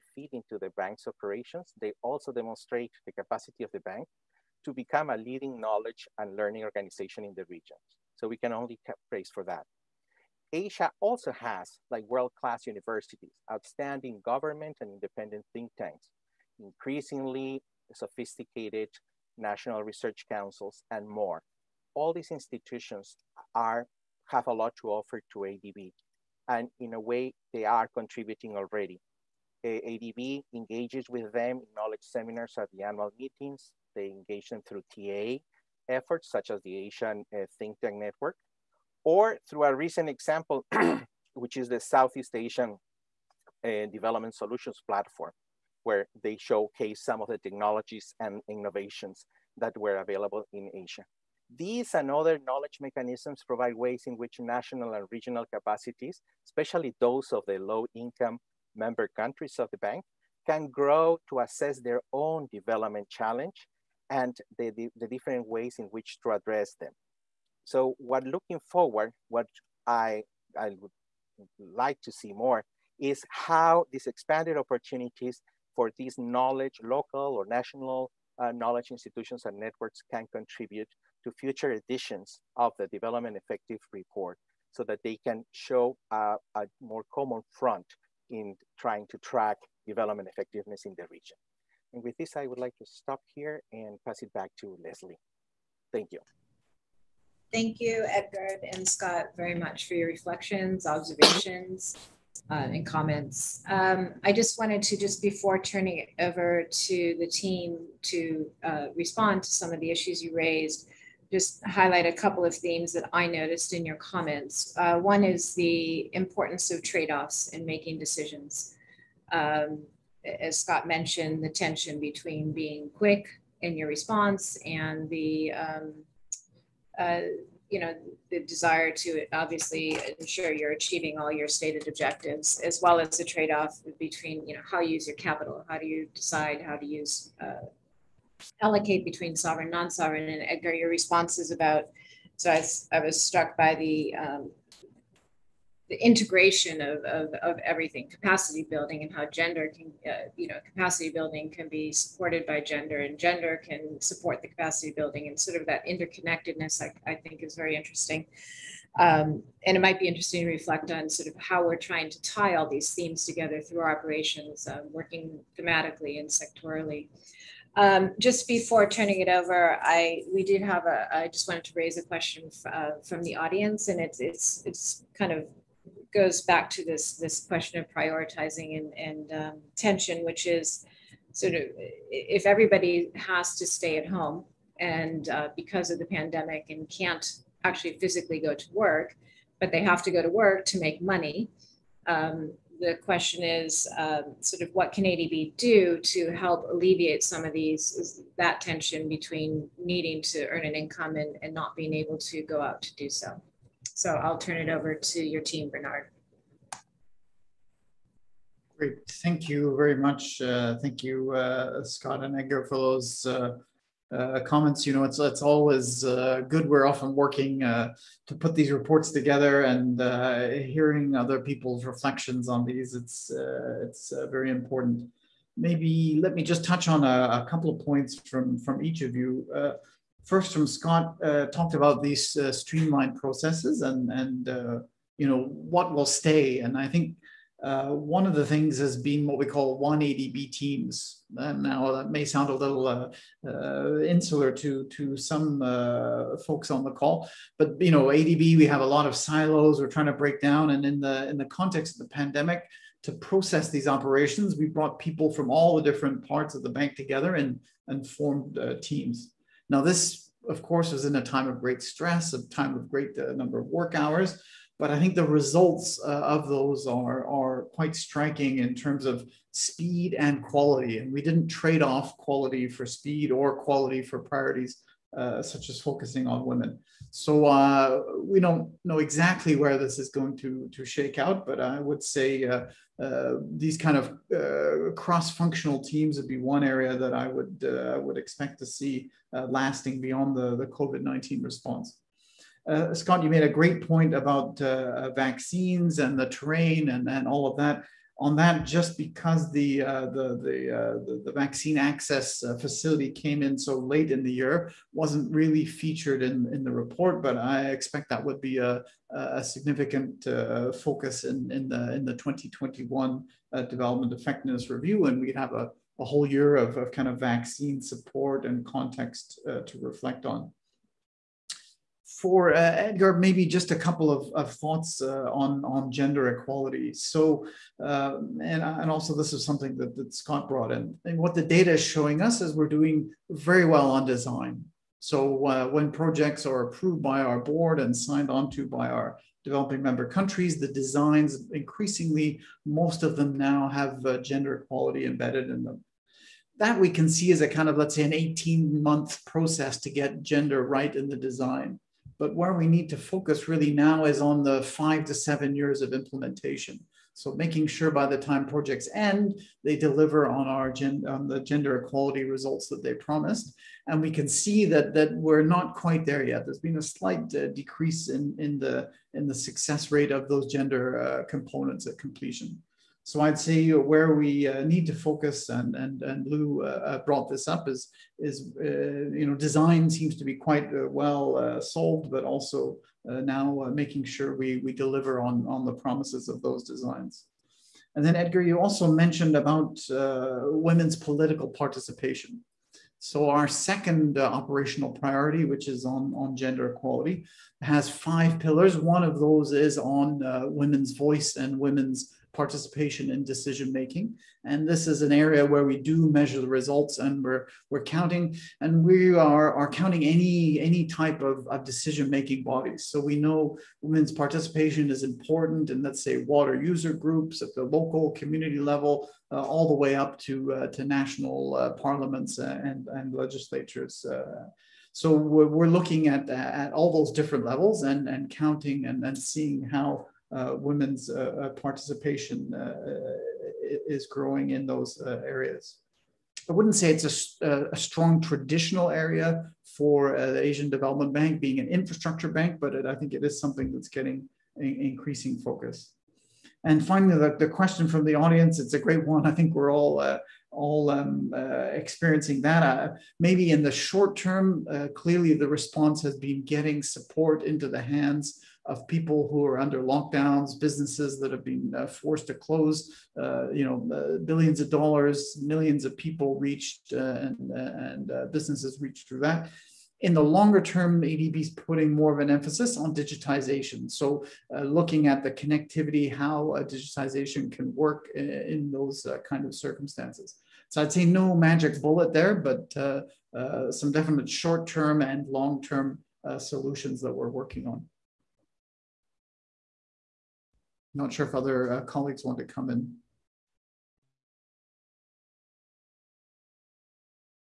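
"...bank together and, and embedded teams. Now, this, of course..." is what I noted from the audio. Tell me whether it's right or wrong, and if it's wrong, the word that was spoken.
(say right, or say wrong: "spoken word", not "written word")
wrong: "formed", not "embedded".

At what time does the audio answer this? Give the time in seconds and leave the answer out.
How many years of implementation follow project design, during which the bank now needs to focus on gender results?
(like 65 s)
354 s.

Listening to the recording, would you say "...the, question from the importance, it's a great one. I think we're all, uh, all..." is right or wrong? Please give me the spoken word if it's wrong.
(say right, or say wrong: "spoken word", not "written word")
wrong: "audience", not "importance".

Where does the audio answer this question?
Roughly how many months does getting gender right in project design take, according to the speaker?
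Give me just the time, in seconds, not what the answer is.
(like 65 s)
348 s.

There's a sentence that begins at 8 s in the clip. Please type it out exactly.
So we can only praise for that.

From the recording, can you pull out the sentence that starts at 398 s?
One of those is on uh, women's voice and women's participation in decision making.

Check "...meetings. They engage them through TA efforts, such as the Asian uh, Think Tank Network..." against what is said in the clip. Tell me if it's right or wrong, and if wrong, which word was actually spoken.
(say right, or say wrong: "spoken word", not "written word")
right.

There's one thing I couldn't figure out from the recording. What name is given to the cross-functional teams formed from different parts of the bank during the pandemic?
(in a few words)
One ADB.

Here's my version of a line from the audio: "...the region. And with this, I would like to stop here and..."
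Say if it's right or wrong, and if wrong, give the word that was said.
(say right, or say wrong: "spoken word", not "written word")
right.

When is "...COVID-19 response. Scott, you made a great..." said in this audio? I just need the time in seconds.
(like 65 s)
290 s.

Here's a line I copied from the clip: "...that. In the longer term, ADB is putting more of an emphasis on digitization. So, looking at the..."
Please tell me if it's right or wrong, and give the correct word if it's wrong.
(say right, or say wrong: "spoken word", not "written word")
right.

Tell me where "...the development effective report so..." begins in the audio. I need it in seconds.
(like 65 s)
82 s.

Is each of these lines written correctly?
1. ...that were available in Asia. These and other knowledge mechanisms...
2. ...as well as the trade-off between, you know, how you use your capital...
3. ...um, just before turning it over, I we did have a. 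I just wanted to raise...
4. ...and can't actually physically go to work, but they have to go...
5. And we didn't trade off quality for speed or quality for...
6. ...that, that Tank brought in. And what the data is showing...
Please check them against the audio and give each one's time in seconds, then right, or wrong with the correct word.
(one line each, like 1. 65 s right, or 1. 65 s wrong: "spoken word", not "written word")
1. 49 s right
2. 132 s right
3. 167 s right
4. 186 s right
5. 270 s right
6. 329 s wrong: "Scott", not "Tank".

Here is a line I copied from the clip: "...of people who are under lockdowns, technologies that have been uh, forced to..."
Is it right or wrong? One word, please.
wrong.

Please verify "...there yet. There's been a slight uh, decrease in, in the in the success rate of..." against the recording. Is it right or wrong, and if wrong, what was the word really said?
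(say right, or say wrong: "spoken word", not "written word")
right.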